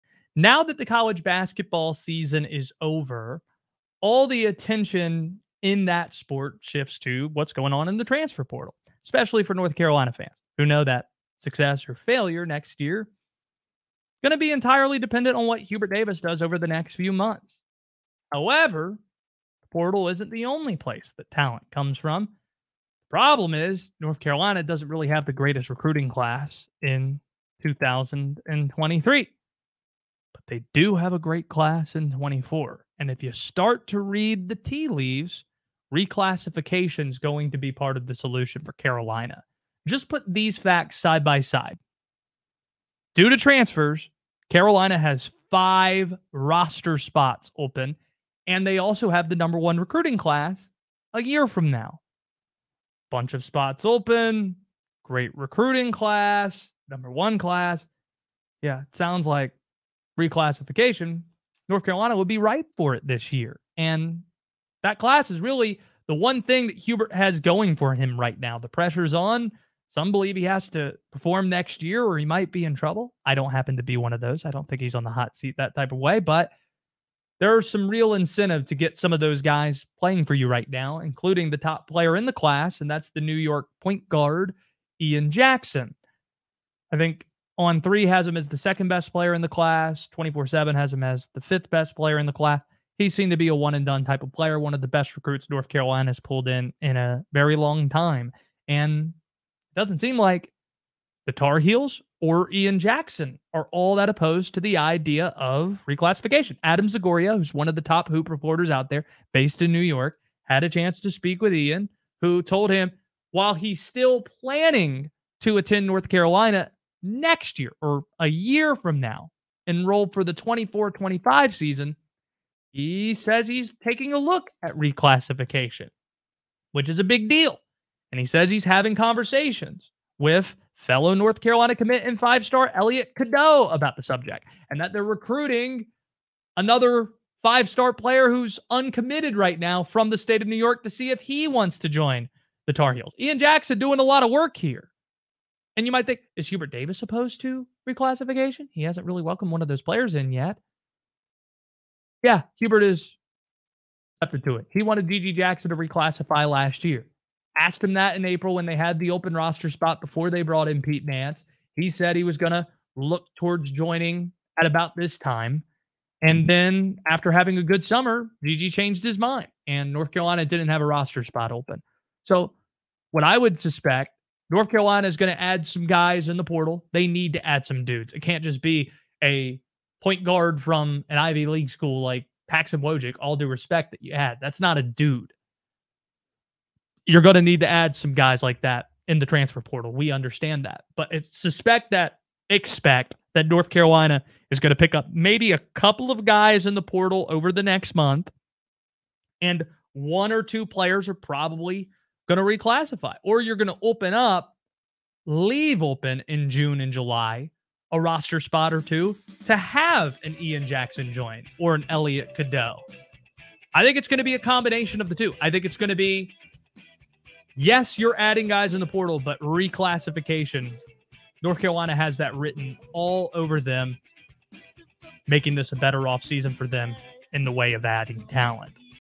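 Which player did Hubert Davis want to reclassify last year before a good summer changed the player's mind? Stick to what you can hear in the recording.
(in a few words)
GG Jackson.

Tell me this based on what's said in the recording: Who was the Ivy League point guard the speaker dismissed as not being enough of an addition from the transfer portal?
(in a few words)
Paxson Wojcik.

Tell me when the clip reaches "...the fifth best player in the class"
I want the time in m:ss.
1:31.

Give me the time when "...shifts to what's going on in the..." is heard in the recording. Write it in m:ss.
0:06.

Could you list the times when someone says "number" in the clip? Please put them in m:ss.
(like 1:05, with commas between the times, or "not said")
0:49, 0:56.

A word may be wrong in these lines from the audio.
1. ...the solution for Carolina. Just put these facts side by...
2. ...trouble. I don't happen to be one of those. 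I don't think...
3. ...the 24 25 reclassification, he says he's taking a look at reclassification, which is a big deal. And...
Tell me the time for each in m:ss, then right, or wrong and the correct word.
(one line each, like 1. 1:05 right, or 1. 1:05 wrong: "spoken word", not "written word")
1. 0:38 right
2. 1:12 right
3. 2:00 wrong: "season", not "reclassification".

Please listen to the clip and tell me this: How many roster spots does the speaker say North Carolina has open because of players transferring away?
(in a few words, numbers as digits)
5.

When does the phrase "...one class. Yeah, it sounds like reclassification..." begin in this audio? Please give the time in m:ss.
0:57.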